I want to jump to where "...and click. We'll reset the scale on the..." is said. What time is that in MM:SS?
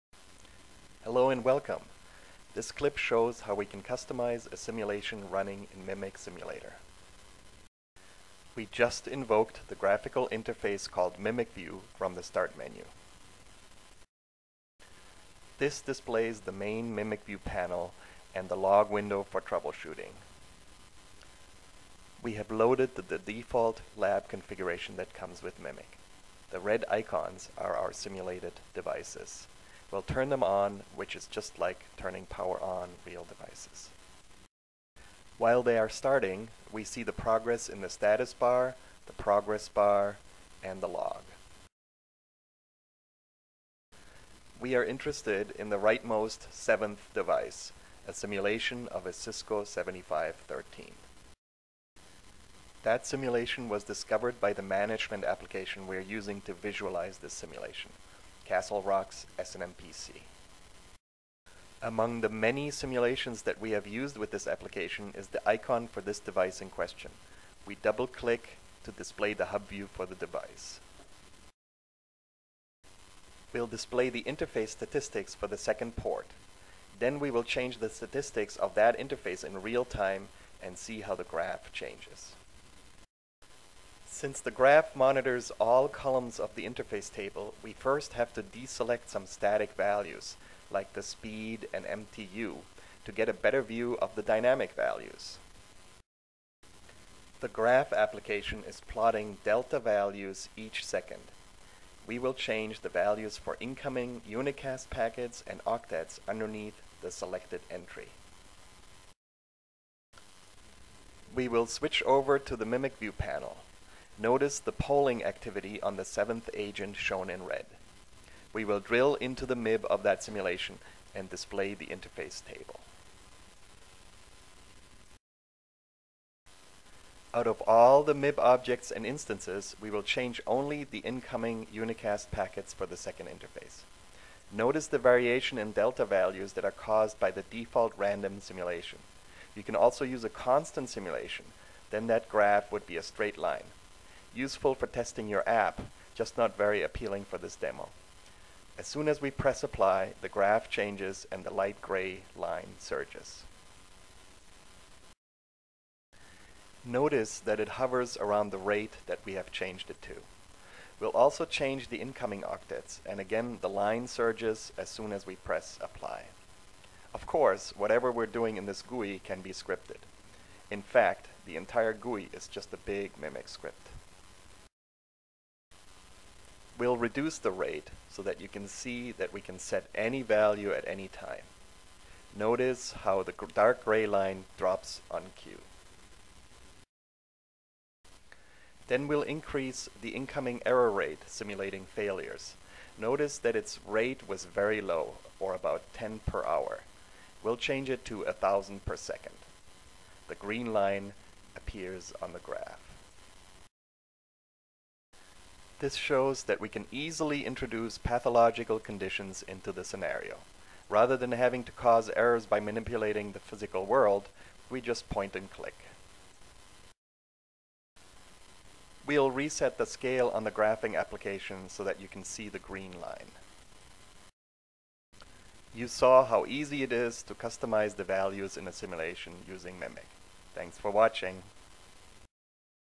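03:35.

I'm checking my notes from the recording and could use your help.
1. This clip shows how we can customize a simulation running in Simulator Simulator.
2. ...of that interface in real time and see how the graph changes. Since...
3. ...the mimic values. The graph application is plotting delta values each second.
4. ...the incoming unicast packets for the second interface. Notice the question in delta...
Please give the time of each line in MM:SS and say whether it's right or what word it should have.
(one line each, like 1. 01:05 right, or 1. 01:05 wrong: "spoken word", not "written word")
1. 00:02 wrong: "Mimic", not "Simulator"
2. 01:18 right
3. 01:34 wrong: "dynamic", not "mimic"
4. 02:10 wrong: "variation", not "question".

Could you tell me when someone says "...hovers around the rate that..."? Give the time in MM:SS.
02:37.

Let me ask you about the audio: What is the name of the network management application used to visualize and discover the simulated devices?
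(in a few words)
SNMPc.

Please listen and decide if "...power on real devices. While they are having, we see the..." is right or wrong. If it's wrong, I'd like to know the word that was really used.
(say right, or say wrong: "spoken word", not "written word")
wrong: "starting", not "having".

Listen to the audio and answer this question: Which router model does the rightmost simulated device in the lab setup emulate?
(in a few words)
Cisco 7513.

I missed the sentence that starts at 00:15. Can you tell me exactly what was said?
This displays the main Mimic View panel and the log window for troubleshooting.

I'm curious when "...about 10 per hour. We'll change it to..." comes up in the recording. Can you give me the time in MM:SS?
03:15.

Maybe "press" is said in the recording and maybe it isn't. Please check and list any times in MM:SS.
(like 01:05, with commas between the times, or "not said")
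02:29, 02:45.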